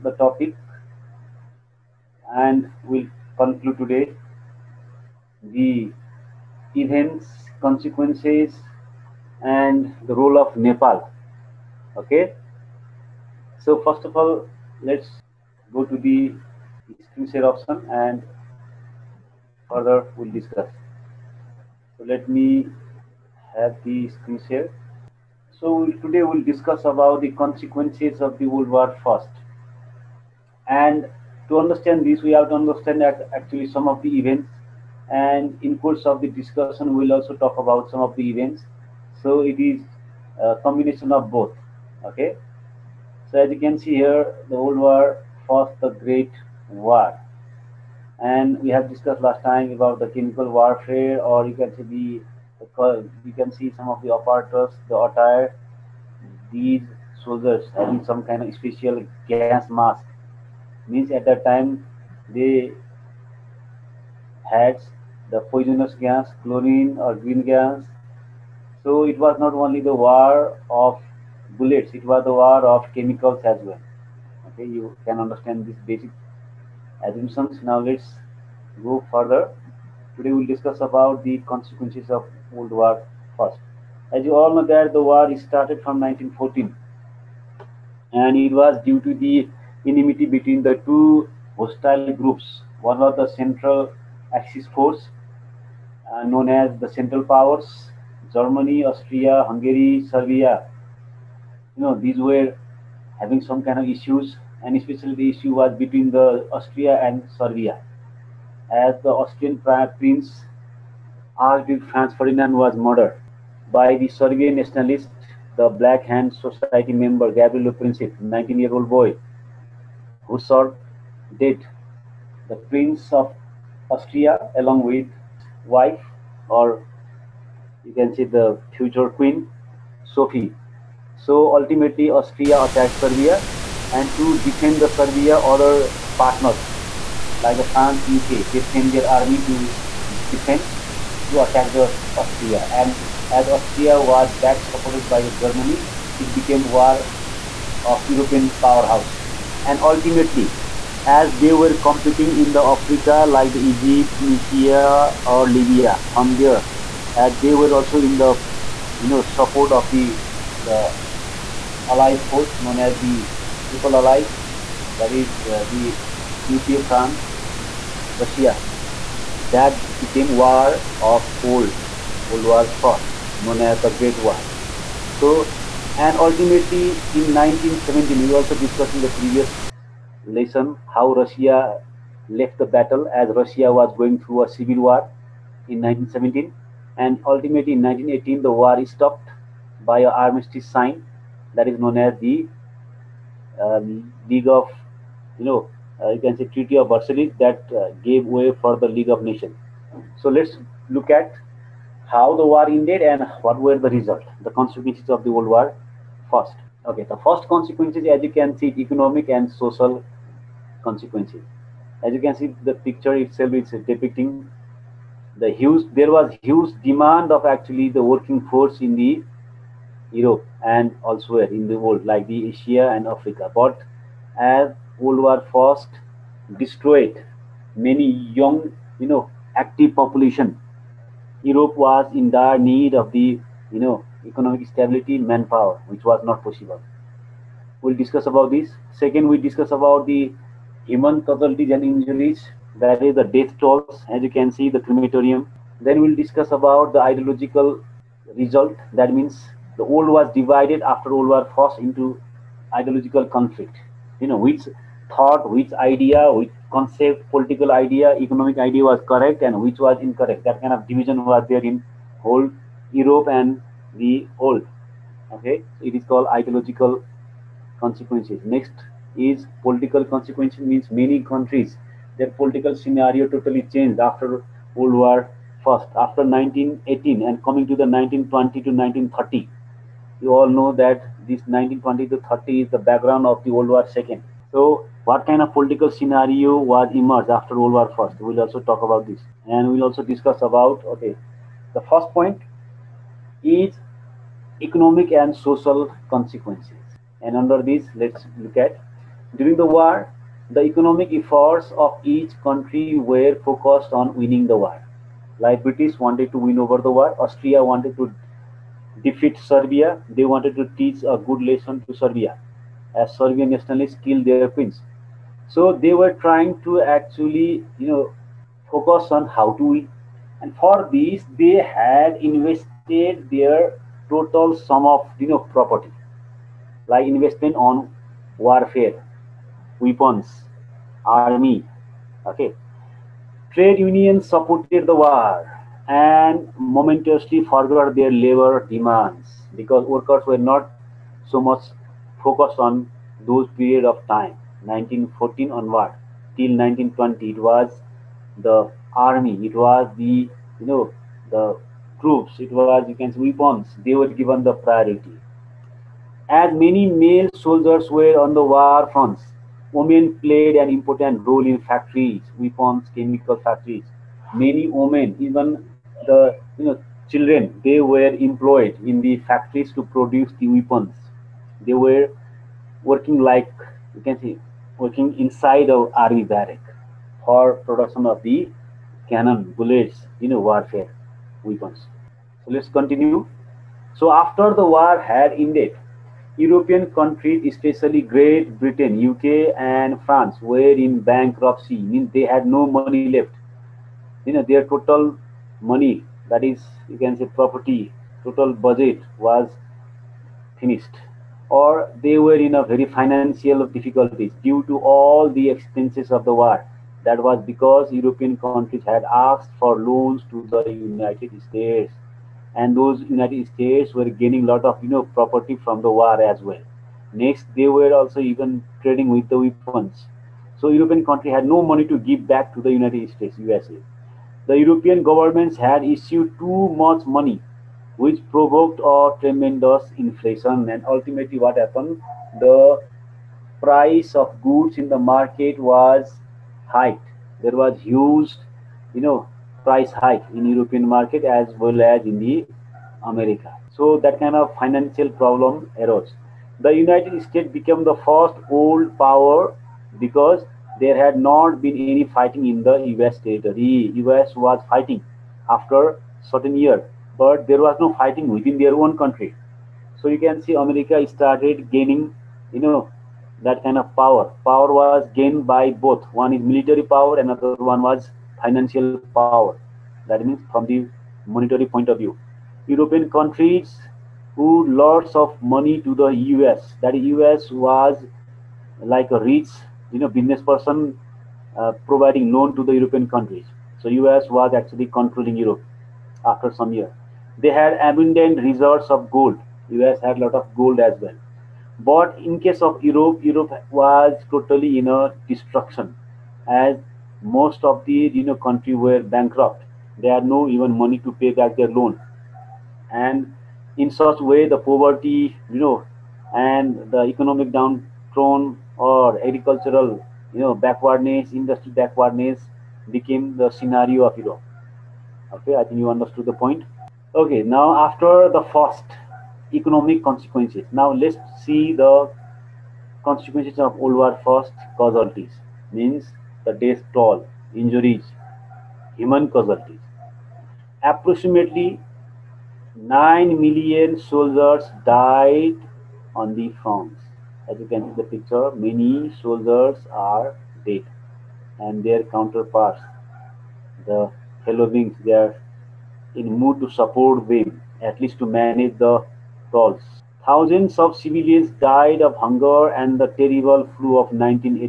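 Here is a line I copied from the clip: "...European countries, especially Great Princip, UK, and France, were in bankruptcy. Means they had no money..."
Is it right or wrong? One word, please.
wrong.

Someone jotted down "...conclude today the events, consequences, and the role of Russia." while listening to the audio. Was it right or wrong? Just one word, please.
wrong.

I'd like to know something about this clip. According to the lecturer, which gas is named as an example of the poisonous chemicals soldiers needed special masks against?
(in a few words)
chlorine.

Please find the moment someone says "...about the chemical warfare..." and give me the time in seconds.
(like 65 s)
49 s.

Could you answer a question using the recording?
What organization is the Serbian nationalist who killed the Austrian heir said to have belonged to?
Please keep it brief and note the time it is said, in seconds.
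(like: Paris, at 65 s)
Black Hand Society, at 115 s.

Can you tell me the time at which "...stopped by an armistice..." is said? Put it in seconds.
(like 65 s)
188 s.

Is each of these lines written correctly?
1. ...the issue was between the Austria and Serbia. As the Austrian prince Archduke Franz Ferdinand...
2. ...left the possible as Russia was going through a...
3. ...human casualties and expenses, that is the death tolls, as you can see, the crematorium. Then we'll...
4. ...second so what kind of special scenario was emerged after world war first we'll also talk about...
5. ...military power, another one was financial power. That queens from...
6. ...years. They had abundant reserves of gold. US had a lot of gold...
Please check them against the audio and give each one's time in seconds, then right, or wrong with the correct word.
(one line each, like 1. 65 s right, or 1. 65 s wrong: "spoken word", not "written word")
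1. 105 s right
2. 182 s wrong: "battle", not "possible"
3. 240 s wrong: "injuries", not "expenses"
4. 283 s wrong: "political", not "special"
5. 466 s wrong: "means", not "queens"
6. 486 s right.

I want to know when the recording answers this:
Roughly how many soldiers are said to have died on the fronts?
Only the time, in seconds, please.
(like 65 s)
532 s.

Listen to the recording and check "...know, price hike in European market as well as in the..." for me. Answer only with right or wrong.
right.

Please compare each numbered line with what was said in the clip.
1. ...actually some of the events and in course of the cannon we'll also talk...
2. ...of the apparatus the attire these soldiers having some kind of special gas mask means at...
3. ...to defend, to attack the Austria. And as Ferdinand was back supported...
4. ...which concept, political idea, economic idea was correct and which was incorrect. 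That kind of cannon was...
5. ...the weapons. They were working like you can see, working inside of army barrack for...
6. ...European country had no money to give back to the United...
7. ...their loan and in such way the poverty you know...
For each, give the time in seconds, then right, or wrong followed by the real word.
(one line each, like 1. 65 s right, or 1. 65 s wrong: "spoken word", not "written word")
1. 33 s wrong: "discussion", not "cannon"
2. 53 s right
3. 139 s wrong: "Austria", not "Ferdinand"
4. 256 s wrong: "division", not "cannon"
5. 370 s right
6. 420 s right
7. 501 s right.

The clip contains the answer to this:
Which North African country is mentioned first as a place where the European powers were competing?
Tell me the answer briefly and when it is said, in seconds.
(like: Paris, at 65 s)
Egypt, at 153 s.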